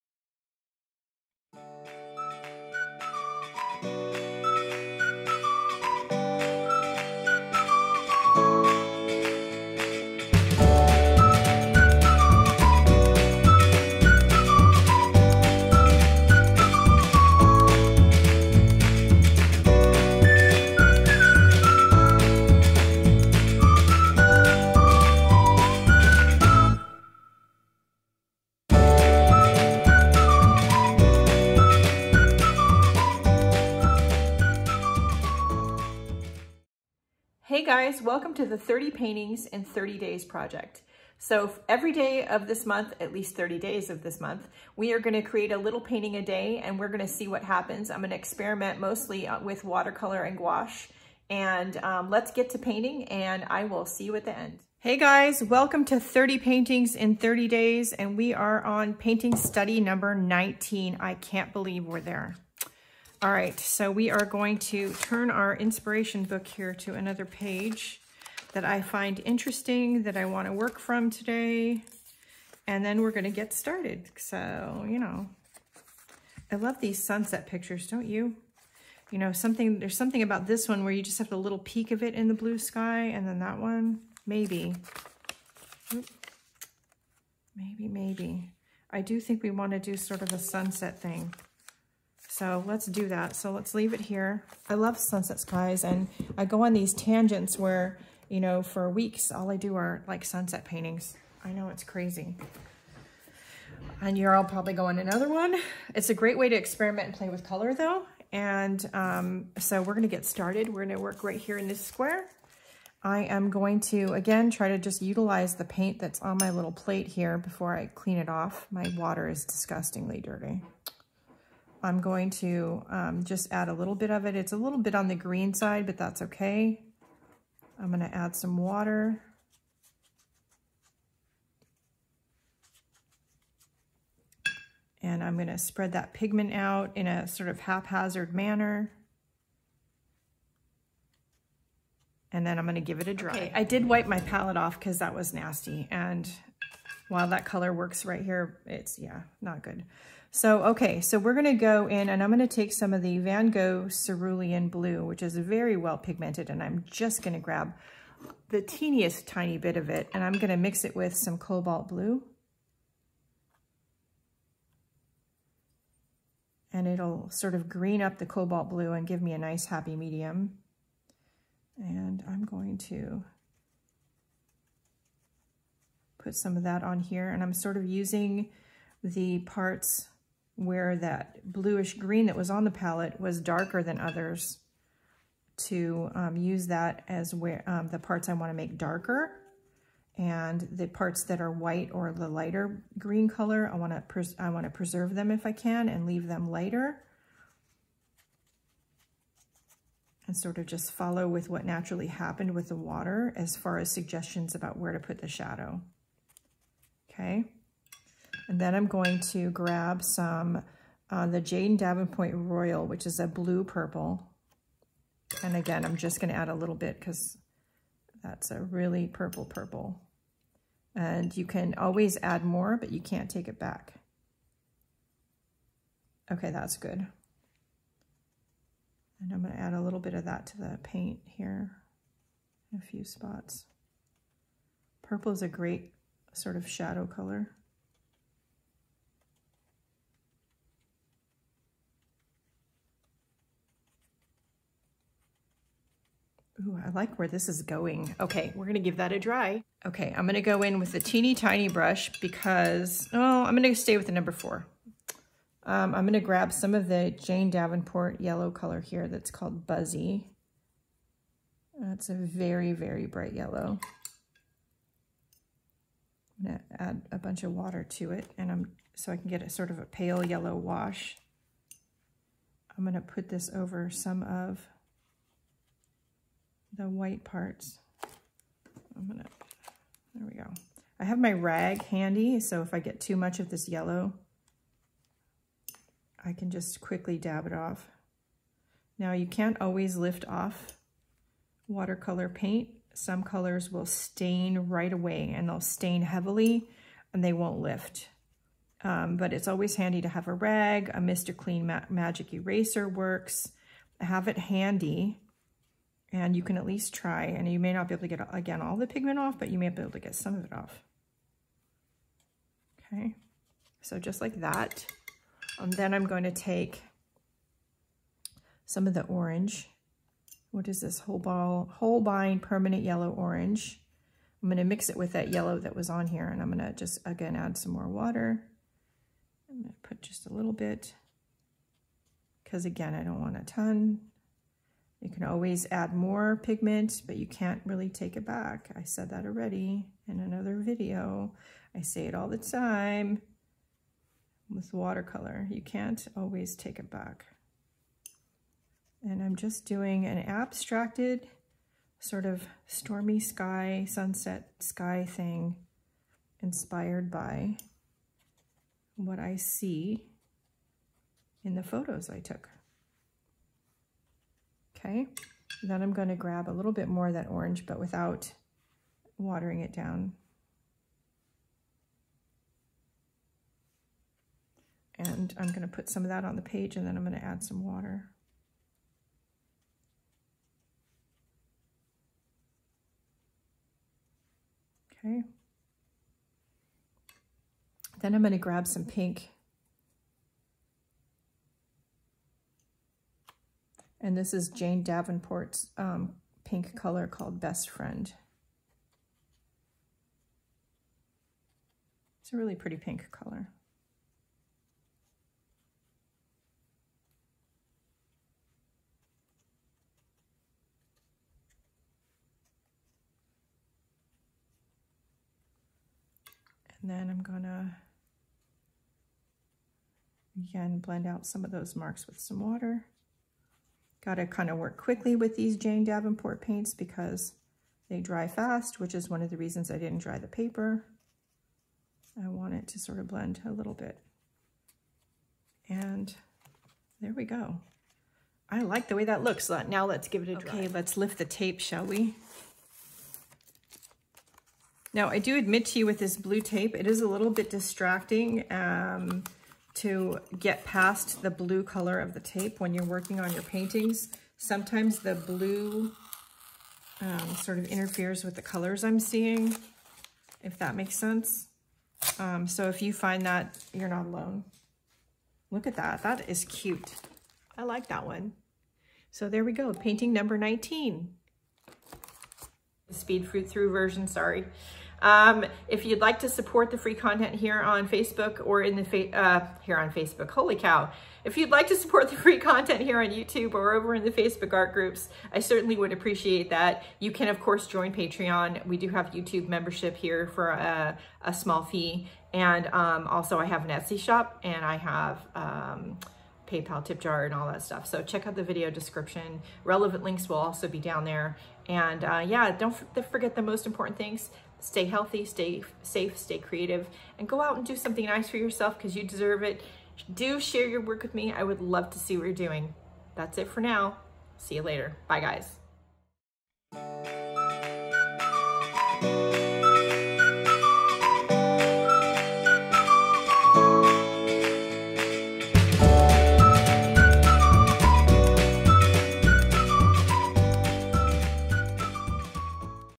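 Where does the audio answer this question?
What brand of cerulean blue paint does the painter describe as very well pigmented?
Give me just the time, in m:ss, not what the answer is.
2:33.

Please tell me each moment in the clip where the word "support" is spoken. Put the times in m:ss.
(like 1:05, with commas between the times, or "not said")
7:56, 8:01.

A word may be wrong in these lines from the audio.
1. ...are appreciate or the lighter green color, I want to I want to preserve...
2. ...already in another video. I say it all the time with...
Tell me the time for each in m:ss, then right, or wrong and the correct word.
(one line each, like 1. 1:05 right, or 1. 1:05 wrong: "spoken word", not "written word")
1. 3:11 wrong: "white", not "appreciate"
2. 5:39 right.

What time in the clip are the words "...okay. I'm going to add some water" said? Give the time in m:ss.
2:06.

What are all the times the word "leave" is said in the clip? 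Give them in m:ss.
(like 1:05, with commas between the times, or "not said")
1:33, 3:16.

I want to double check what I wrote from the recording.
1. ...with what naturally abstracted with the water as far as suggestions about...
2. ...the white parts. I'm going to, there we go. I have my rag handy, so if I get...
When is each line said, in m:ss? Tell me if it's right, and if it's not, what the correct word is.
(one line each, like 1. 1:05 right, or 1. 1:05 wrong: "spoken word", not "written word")
1. 3:21 wrong: "happened", not "abstracted"
2. 4:36 right.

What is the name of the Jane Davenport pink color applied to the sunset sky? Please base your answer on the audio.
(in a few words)
Best Friend.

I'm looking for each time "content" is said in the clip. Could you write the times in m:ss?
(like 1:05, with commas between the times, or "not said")
7:56, 8:02.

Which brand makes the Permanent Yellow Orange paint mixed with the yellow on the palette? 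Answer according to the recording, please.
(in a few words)
Holbein.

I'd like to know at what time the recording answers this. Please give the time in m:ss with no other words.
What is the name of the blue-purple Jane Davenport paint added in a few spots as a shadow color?
3:32.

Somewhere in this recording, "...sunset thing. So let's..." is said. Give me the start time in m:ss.
1:30.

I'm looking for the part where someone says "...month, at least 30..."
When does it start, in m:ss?
0:42.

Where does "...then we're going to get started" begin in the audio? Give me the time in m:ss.
1:12.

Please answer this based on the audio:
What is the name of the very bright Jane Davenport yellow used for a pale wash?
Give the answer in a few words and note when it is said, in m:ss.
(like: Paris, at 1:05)
Buzzy, at 4:19.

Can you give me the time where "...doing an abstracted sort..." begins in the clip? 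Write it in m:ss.
5:49.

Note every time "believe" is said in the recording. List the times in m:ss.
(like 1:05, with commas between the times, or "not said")
1:01.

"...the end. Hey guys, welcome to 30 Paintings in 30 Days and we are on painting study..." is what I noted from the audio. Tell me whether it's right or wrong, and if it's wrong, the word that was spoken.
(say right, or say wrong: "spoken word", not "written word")
right.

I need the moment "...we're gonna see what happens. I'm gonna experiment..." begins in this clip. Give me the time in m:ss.
0:46.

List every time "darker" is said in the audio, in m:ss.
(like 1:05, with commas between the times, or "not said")
3:03, 3:08.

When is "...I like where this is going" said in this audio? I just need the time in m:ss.
4:06.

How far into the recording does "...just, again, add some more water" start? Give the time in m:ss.
5:26.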